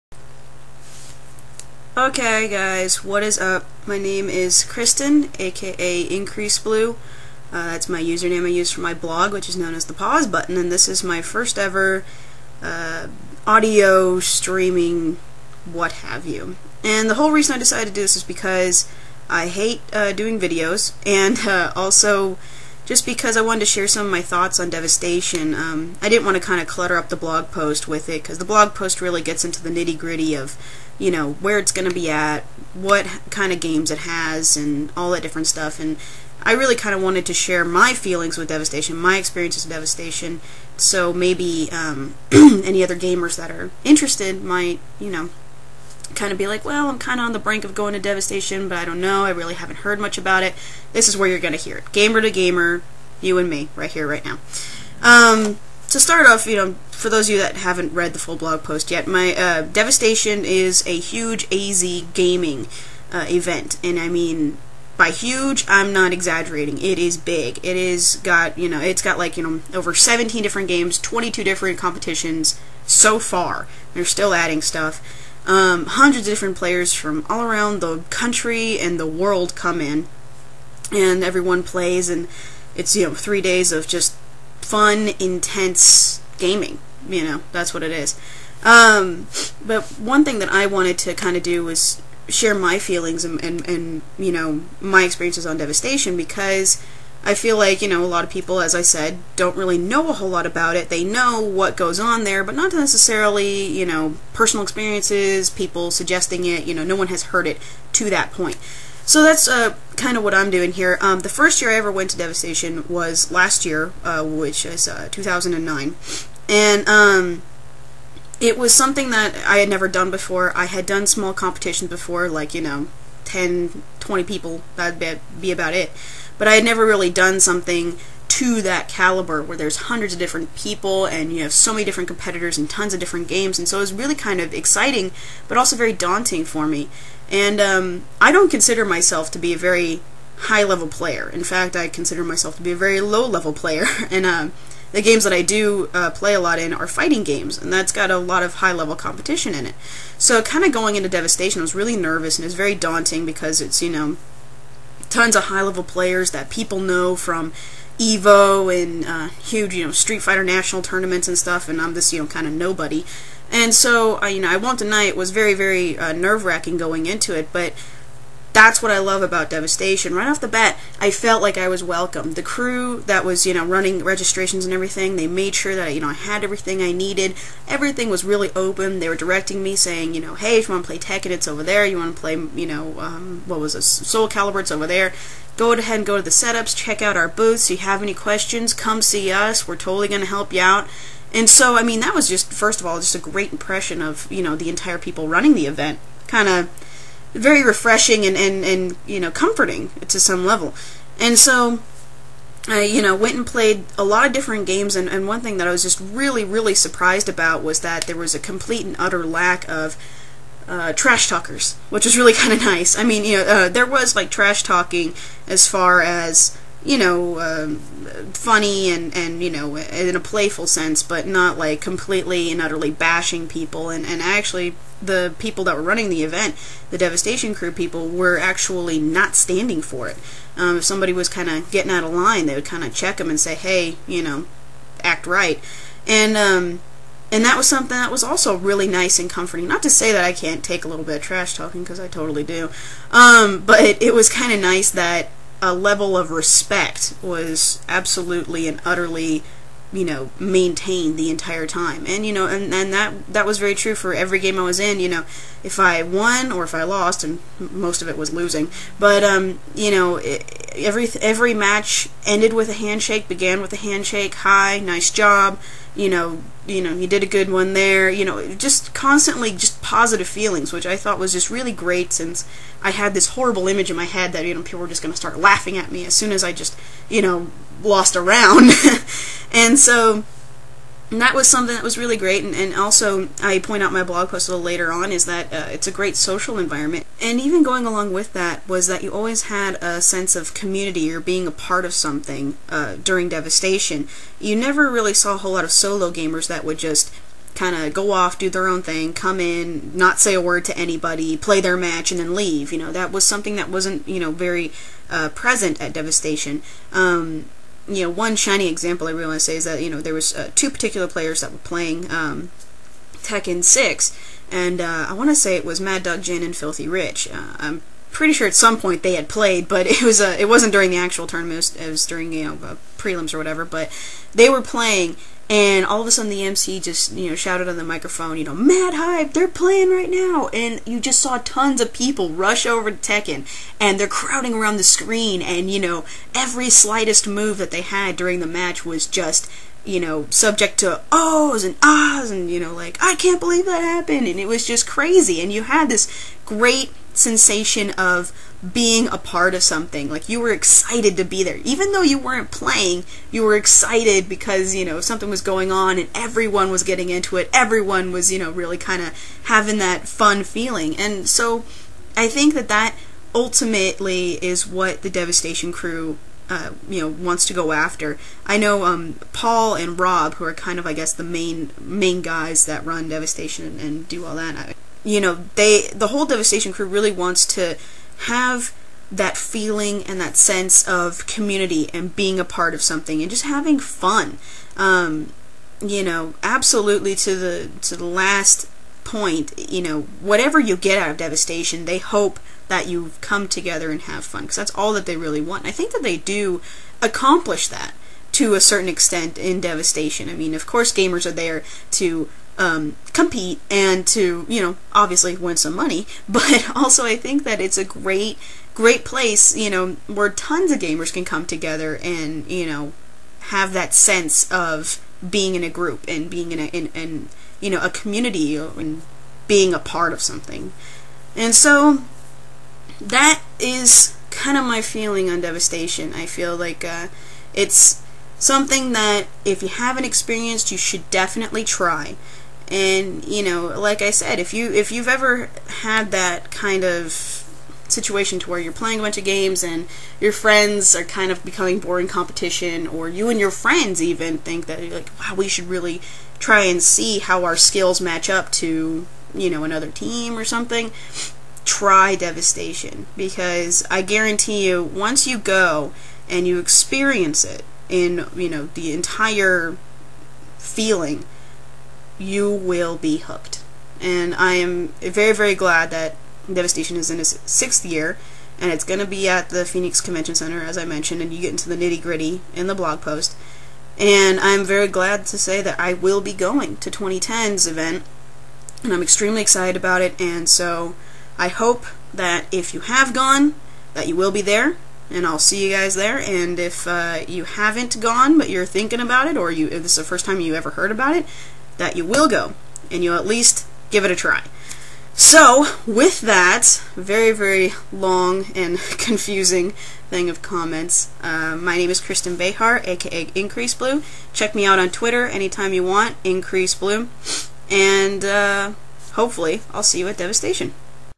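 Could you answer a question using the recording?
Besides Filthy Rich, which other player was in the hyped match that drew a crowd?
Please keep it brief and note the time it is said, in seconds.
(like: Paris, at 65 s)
Mad Dog Jin, at 315 s.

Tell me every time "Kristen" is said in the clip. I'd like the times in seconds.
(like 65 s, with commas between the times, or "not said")
4 s, 502 s.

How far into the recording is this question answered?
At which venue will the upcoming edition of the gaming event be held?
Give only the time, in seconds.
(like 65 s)
469 s.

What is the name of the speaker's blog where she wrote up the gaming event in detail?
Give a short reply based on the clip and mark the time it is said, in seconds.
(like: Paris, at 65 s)
The Pause Button, at 9 s.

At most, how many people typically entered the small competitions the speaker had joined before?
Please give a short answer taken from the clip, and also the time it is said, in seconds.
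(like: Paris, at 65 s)
20, at 123 s.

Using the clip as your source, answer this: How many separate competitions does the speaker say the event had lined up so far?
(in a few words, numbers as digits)
22.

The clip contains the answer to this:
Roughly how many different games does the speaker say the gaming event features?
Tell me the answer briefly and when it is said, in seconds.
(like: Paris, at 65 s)
over 17, at 69 s.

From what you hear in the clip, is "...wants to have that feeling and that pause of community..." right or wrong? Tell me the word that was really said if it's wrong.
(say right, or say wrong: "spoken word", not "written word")
wrong: "sense", not "pause".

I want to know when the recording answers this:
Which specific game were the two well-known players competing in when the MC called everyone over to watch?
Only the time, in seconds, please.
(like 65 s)
313 s.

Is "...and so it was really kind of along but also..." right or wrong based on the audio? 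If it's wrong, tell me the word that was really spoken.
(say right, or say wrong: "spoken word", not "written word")
wrong: "exciting", not "along".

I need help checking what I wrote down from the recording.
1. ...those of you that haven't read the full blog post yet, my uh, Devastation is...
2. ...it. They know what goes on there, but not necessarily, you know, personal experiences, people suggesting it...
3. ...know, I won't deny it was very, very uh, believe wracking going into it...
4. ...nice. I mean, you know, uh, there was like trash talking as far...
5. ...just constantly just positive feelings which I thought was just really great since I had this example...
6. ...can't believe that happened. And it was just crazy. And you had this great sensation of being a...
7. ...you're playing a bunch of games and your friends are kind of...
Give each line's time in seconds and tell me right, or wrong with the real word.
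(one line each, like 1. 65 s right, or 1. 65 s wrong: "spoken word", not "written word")
1. 57 s right
2. 100 s right
3. 164 s wrong: "nerve", not "believe"
4. 212 s right
5. 268 s wrong: "horrible", not "example"
6. 343 s right
7. 438 s right.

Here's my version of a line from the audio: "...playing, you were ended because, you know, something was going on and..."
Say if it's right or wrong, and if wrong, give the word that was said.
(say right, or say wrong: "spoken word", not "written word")
wrong: "excited", not "ended".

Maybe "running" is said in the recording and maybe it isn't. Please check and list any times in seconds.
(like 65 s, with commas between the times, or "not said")
173 s, 195 s, 225 s.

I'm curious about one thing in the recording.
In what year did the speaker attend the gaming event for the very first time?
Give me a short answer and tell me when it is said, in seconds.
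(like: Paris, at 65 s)
2009, at 115 s.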